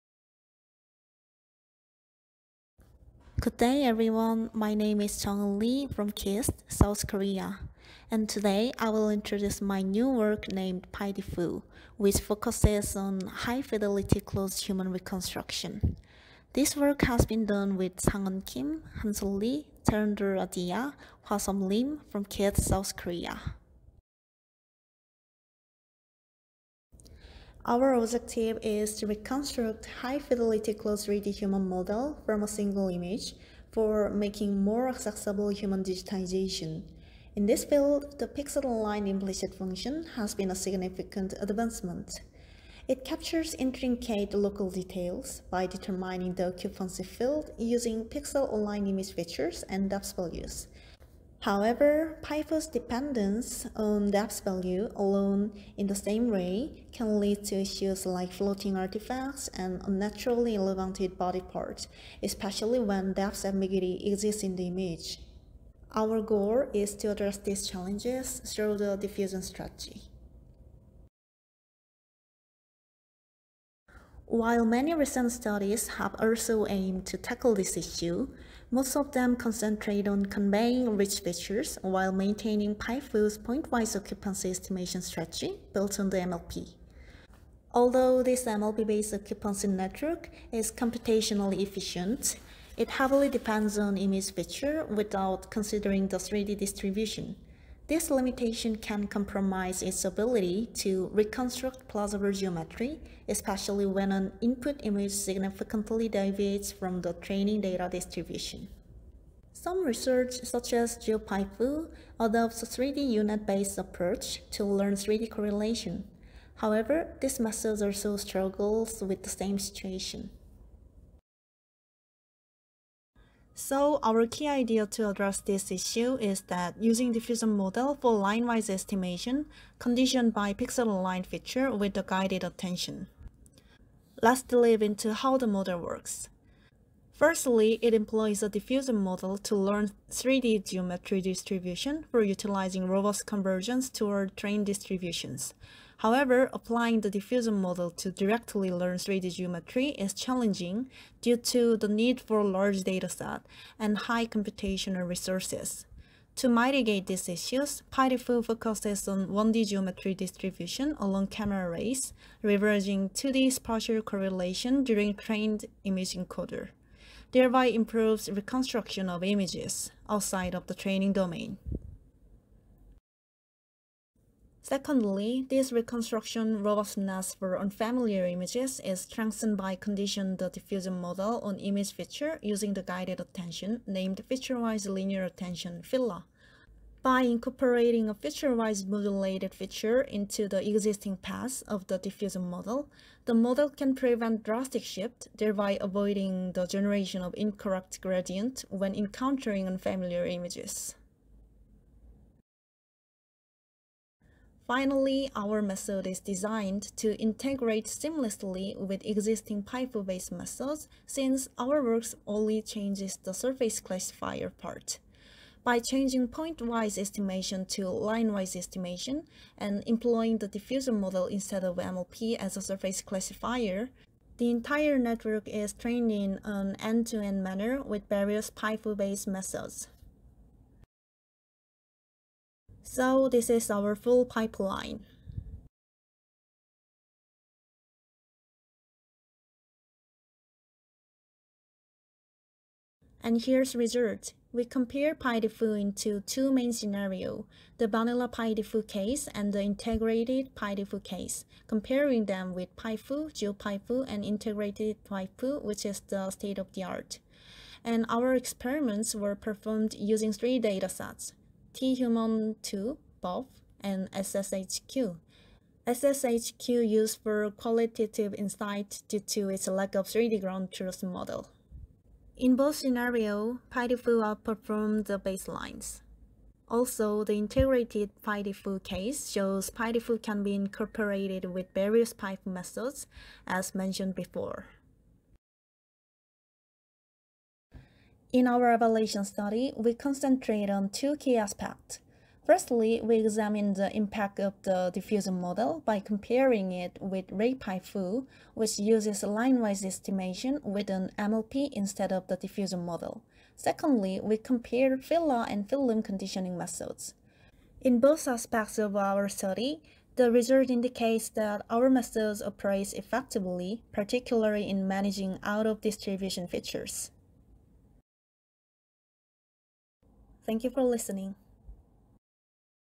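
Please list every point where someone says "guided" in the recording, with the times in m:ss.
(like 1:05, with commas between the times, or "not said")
2:12, 3:02.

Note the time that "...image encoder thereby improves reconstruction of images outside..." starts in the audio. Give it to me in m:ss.
2:45.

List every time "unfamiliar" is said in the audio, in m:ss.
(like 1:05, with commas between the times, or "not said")
2:57, 3:19.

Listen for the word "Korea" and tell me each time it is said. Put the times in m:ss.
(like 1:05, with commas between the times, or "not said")
0:07, 0:22.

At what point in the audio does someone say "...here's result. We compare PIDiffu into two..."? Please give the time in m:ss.
4:03.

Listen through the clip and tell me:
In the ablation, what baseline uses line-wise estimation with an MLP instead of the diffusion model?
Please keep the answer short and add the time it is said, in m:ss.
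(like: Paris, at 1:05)
RayPIFu, at 4:57.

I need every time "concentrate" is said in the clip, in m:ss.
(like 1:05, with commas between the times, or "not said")
1:19, 4:49.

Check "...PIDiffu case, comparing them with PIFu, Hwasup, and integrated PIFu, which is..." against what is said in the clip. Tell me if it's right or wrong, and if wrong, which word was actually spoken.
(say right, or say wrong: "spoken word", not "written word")
wrong: "GeoPIFu", not "Hwasup".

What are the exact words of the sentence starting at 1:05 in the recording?
Our goal is to address these challenges through the diffusion strategy.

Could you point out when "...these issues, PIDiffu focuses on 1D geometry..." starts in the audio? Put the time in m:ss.
2:37.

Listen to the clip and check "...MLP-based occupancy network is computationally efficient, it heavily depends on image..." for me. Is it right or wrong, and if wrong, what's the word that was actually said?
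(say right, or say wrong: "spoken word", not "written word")
right.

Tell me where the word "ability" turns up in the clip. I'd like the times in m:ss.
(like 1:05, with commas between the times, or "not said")
1:40.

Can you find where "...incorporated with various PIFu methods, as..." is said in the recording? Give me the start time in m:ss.
4:40.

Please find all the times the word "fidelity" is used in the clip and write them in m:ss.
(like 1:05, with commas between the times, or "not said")
0:13, 0:29.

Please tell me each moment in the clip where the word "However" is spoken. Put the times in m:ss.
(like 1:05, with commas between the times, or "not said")
0:51, 1:56, 2:25.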